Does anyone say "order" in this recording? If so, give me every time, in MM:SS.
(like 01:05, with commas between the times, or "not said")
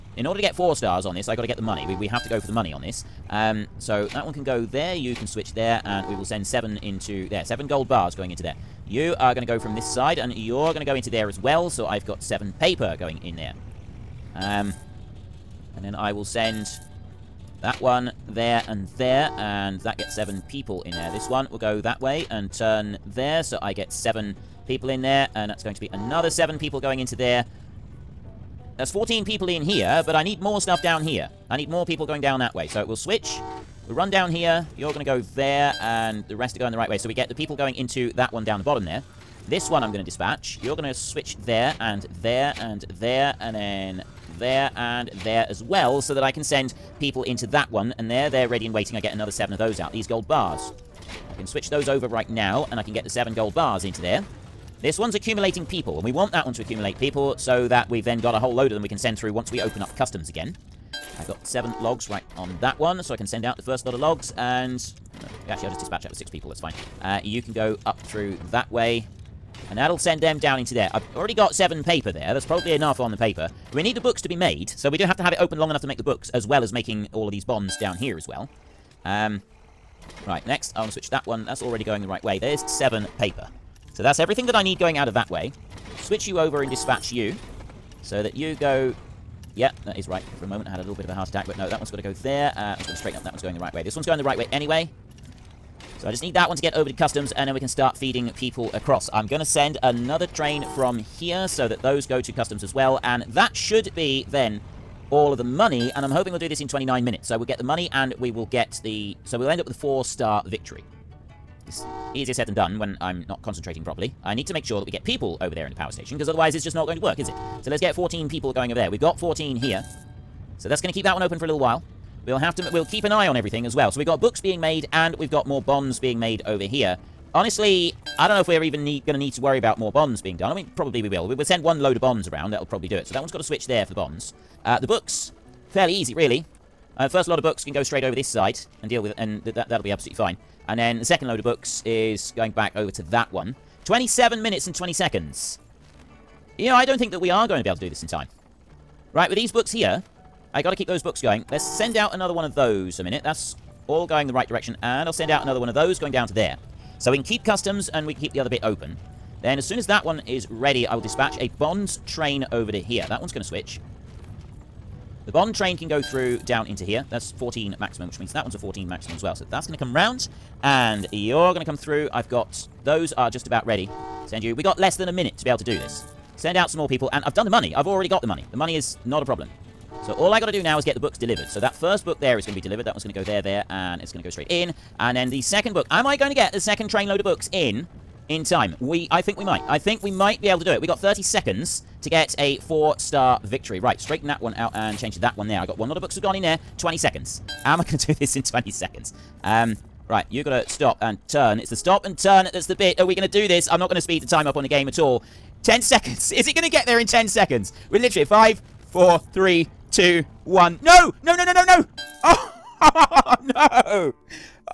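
00:00.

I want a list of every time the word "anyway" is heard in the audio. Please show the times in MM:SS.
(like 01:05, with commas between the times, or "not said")
01:34.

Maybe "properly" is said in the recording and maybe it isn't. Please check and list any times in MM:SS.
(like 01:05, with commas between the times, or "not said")
01:53.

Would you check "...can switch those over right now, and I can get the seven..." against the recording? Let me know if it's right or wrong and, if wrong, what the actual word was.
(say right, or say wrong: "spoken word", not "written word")
right.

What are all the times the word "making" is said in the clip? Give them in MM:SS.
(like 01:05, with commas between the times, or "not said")
01:16.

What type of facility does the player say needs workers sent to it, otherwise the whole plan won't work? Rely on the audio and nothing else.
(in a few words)
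Power station.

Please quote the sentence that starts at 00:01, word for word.
We, we have to go for the money on this.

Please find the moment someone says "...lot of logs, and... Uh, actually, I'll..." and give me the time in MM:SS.
01:03.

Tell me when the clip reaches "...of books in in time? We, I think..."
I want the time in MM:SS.
03:07.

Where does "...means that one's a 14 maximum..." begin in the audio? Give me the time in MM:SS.
02:48.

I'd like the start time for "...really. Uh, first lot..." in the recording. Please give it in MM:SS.
02:16.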